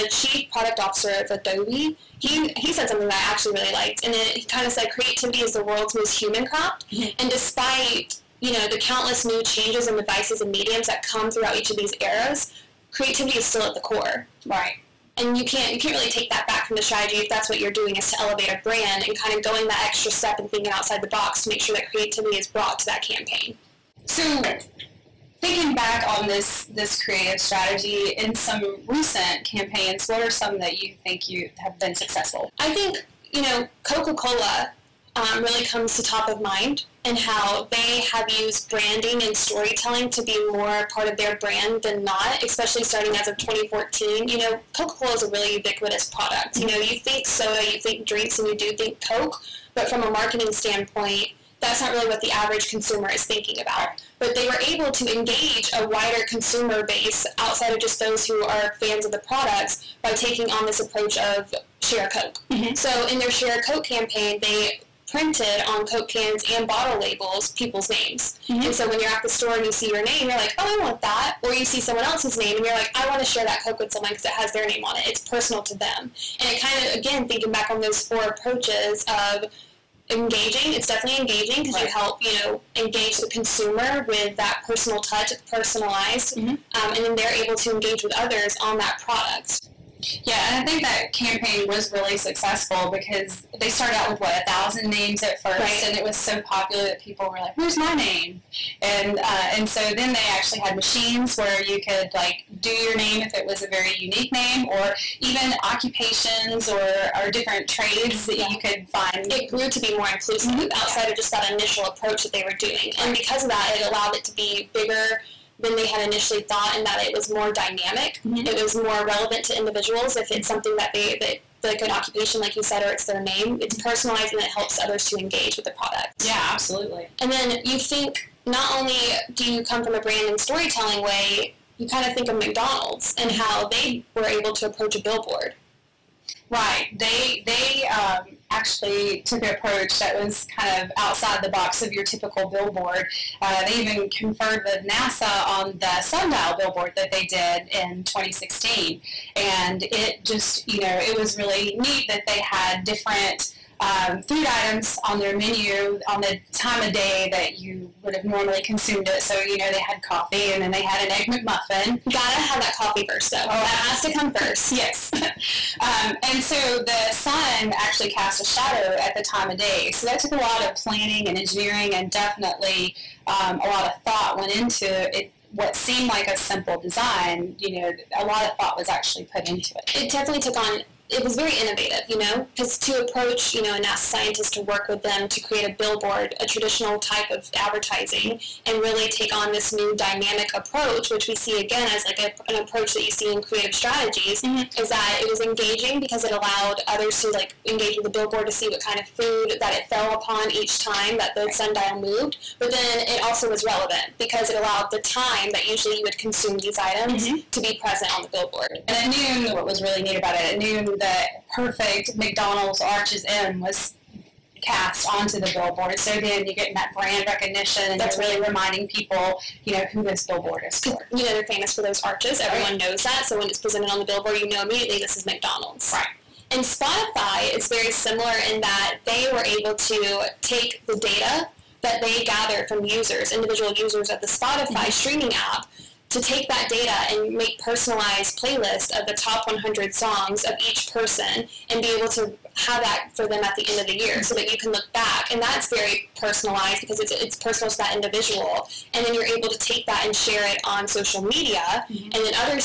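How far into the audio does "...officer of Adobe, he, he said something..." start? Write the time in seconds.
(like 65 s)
0 s.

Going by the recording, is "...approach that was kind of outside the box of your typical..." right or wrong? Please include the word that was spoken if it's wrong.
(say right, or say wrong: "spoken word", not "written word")
right.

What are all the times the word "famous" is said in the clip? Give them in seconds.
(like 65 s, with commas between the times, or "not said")
221 s.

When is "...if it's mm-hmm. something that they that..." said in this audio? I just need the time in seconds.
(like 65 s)
120 s.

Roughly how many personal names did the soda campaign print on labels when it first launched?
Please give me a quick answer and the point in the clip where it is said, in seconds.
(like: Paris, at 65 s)
1000, at 94 s.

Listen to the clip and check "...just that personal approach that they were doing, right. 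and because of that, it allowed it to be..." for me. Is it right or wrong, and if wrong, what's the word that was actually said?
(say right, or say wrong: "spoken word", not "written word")
wrong: "initial", not "personal".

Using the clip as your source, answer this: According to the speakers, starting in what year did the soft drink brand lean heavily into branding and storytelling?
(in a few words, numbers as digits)
2014.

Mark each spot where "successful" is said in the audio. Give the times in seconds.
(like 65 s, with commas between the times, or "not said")
31 s, 92 s.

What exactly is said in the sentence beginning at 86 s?
um, and then they're able to engage with others on that product.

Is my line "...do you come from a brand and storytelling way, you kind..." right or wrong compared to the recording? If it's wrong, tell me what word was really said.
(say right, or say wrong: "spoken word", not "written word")
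right.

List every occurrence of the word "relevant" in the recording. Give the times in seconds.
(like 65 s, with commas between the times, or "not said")
119 s, 203 s.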